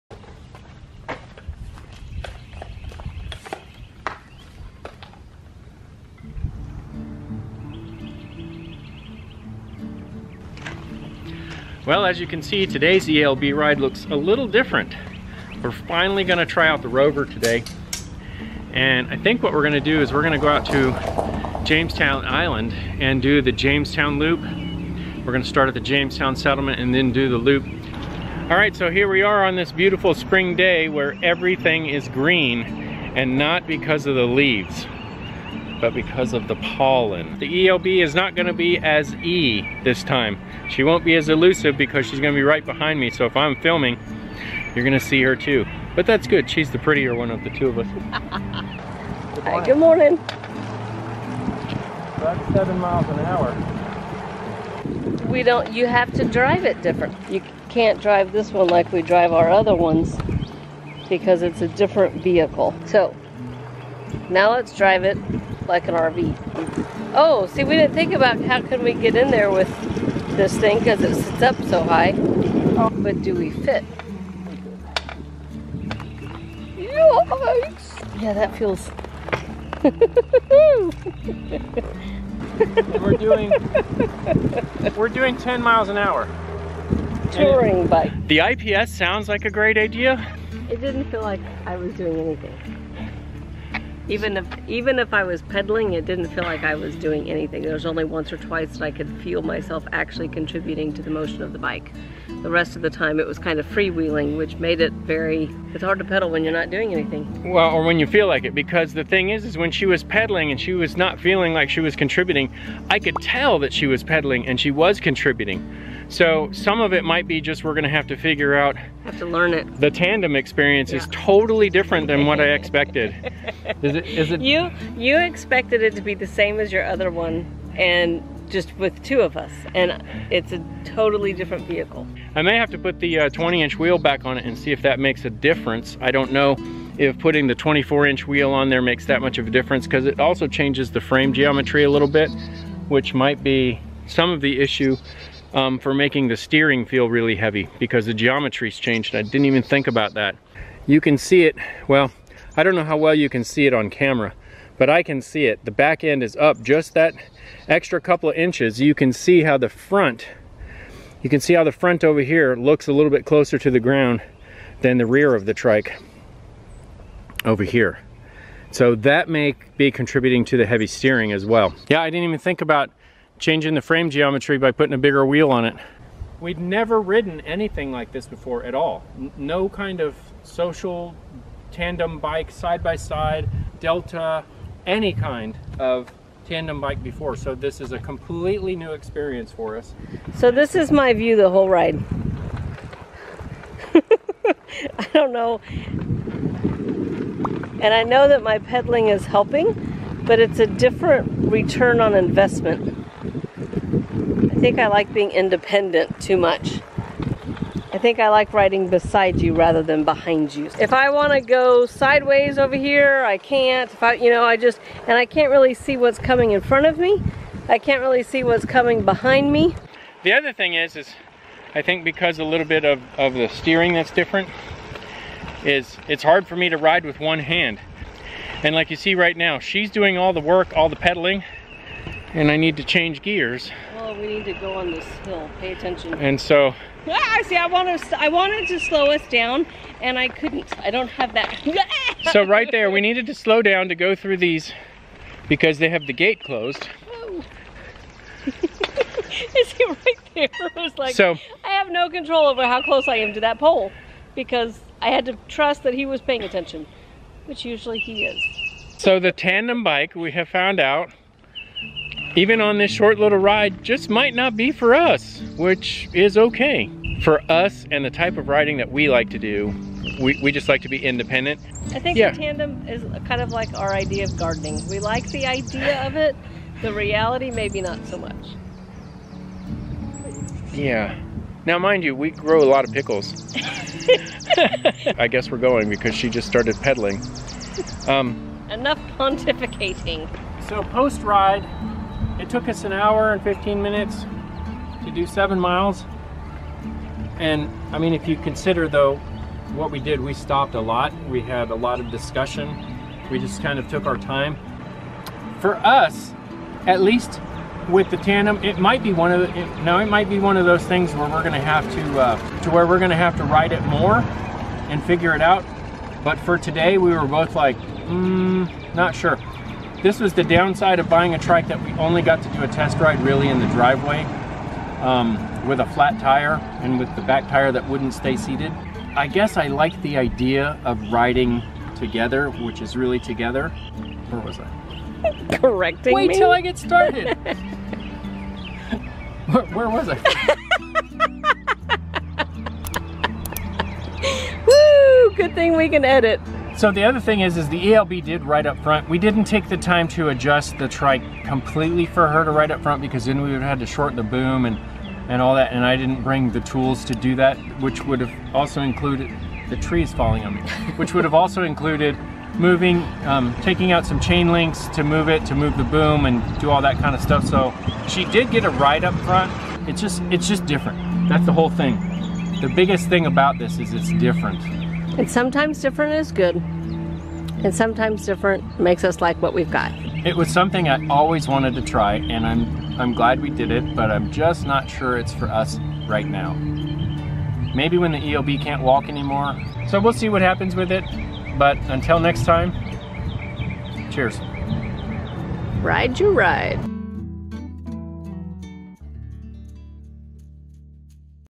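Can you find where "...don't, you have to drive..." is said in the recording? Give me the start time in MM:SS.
00:55.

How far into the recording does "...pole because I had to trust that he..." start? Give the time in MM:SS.
04:13.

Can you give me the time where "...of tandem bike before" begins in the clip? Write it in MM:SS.
03:05.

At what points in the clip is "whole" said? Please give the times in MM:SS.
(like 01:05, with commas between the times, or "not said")
03:11, 06:11.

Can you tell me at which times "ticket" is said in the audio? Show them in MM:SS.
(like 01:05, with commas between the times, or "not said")
not said.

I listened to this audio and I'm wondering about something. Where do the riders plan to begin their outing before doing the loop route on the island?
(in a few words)
Jamestown Settlement.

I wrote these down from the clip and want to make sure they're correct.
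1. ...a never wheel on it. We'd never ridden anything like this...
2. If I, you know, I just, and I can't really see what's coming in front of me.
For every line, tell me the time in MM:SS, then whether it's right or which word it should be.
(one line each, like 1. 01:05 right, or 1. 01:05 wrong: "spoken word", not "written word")
1. 02:54 wrong: "bigger", not "never"
2. 03:33 right.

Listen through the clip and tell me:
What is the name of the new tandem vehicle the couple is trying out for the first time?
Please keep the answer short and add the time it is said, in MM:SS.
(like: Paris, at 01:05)
the Rover, at 00:16.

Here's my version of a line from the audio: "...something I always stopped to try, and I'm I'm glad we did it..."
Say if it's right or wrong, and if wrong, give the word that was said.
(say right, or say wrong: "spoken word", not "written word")
wrong: "wanted", not "stopped".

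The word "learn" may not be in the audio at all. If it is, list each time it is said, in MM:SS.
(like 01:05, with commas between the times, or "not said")
01:59.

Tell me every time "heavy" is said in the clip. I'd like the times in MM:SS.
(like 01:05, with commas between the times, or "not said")
02:27, 02:50.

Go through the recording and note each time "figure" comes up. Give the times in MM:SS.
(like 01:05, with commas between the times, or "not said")
01:58, 05:15.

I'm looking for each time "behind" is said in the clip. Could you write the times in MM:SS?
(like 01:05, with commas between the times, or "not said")
00:42, 03:30, 03:39.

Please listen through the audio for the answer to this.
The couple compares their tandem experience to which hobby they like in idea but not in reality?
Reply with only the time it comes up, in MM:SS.
04:34.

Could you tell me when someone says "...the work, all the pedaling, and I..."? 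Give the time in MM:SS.
03:50.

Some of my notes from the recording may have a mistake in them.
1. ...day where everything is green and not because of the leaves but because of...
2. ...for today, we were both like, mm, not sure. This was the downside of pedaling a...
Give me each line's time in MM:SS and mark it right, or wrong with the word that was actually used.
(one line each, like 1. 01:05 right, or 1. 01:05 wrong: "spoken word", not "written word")
1. 00:30 right
2. 05:16 wrong: "buying", not "pedaling".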